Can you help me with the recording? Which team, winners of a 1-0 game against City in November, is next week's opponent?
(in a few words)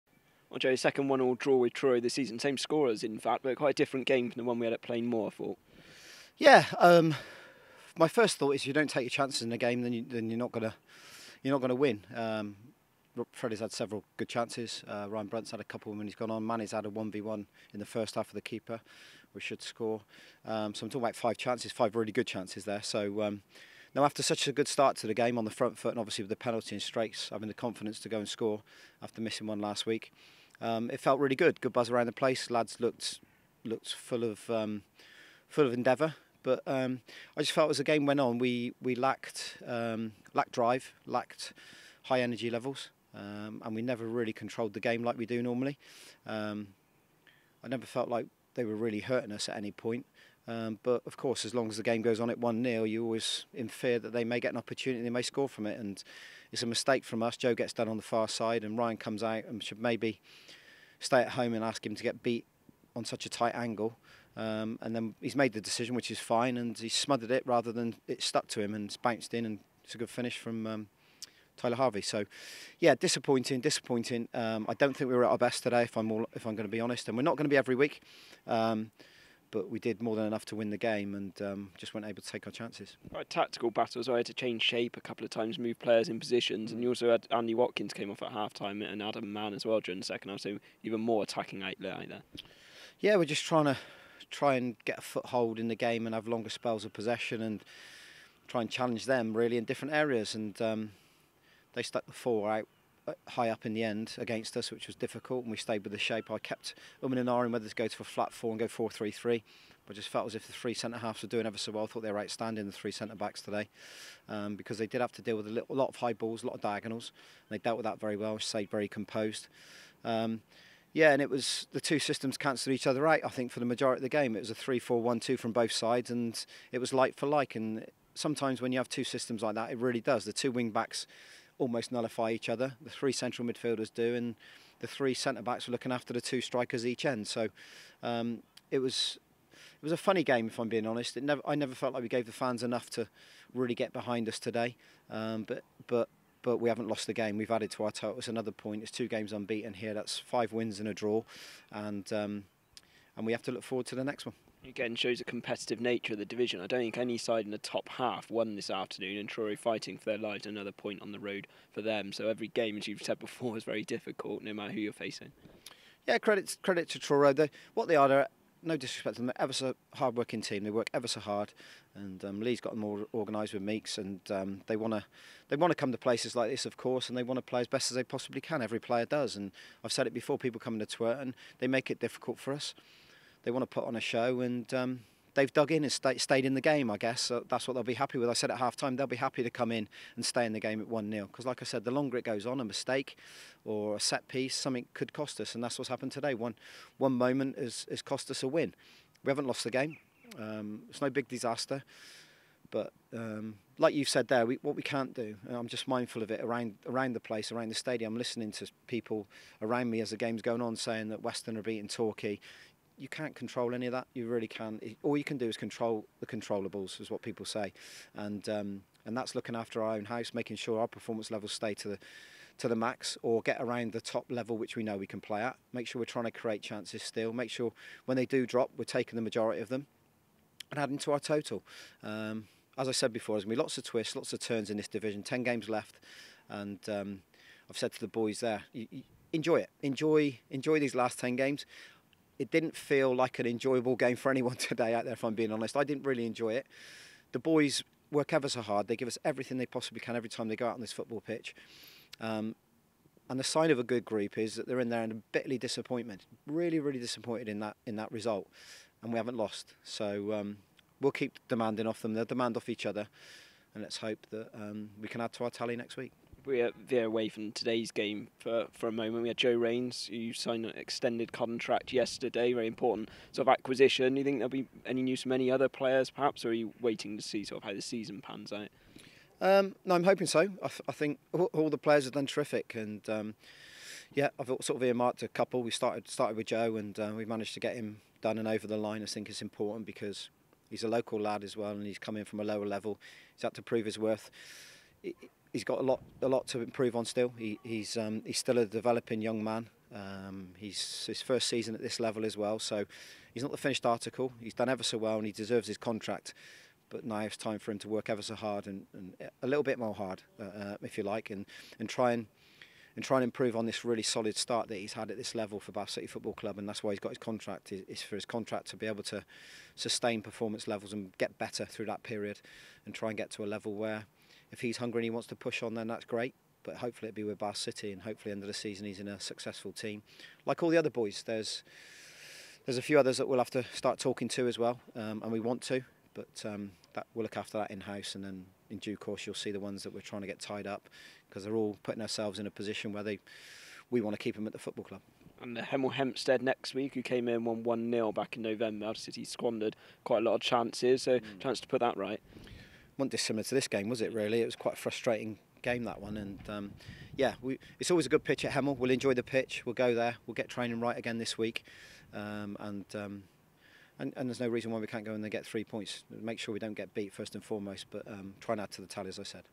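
Hemel Hempstead.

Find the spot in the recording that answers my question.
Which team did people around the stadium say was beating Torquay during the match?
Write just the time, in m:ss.
3:31.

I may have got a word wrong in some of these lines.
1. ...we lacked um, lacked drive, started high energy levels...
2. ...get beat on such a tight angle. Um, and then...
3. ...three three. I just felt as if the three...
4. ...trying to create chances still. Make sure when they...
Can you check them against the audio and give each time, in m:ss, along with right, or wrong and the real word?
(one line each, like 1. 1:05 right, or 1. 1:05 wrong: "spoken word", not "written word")
1. 0:38 wrong: "lacked", not "started"
2. 1:02 right
3. 1:48 right
4. 3:46 right.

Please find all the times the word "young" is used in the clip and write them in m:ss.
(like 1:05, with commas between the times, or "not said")
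4:59.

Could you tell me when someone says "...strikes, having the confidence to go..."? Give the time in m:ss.
0:26.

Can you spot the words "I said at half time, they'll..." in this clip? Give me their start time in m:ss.
3:08.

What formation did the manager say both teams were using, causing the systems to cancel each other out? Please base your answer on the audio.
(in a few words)
3-4-1-2.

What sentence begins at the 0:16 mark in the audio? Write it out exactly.
Manny's had a 1v1 in the first half of the keeper, which should score.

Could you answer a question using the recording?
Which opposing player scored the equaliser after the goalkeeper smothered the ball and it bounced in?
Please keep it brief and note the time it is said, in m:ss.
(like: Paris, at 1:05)
Tyler Harvey, at 1:11.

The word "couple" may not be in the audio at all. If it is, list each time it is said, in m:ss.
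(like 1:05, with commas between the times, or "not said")
0:15, 1:25, 4:45.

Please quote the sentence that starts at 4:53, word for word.
He's had to prove his worth.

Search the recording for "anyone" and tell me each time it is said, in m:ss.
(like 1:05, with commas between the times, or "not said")
4:04.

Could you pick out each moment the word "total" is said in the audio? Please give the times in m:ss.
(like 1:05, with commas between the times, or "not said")
2:27, 3:51.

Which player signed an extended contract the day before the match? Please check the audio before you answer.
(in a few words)
Joe Rains.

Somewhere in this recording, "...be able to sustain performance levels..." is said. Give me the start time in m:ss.
5:18.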